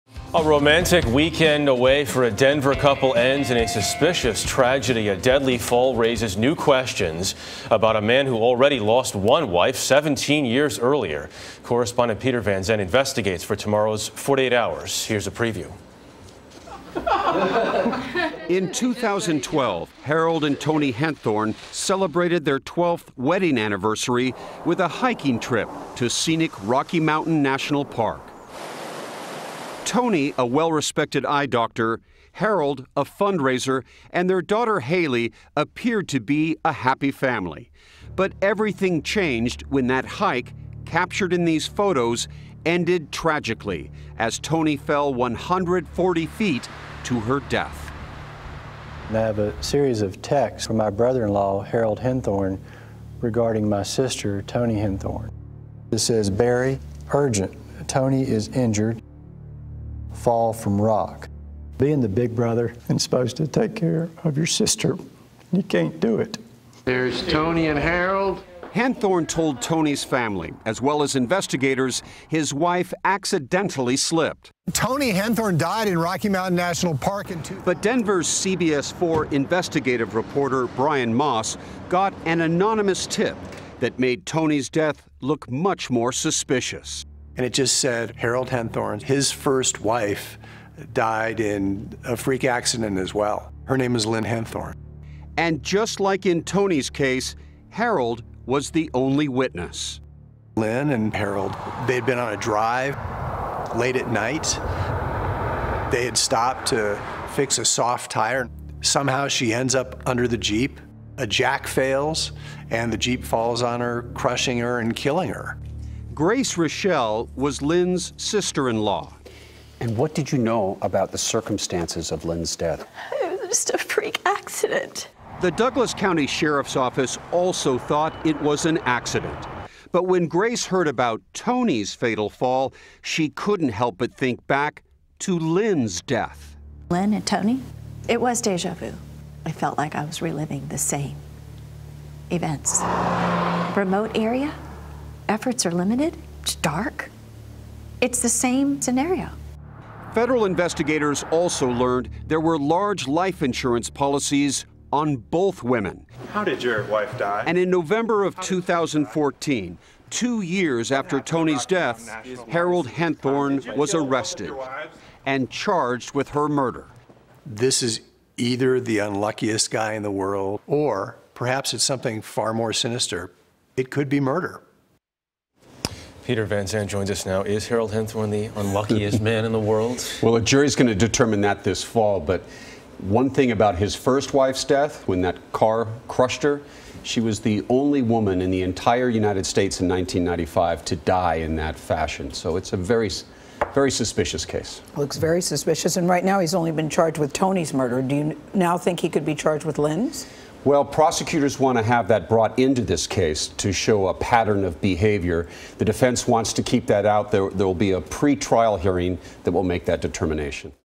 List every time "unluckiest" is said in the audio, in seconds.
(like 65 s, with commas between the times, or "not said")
168 s, 178 s.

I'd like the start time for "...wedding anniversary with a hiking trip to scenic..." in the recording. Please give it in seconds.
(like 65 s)
23 s.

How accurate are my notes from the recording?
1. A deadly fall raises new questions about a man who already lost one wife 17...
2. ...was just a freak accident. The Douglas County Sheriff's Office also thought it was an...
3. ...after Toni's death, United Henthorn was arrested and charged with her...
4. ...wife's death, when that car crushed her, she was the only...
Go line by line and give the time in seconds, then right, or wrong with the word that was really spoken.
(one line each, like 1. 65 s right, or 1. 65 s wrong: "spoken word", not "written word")
1. 5 s right
2. 123 s right
3. 160 s wrong: "Harold", not "United"
4. 184 s right.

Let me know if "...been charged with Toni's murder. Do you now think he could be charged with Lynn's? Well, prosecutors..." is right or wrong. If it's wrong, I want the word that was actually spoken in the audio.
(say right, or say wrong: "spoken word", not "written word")
right.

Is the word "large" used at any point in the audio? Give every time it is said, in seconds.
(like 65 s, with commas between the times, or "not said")
152 s.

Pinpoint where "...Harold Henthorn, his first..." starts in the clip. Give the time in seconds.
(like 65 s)
88 s.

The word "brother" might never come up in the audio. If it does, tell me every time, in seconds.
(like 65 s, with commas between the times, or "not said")
50 s, 62 s.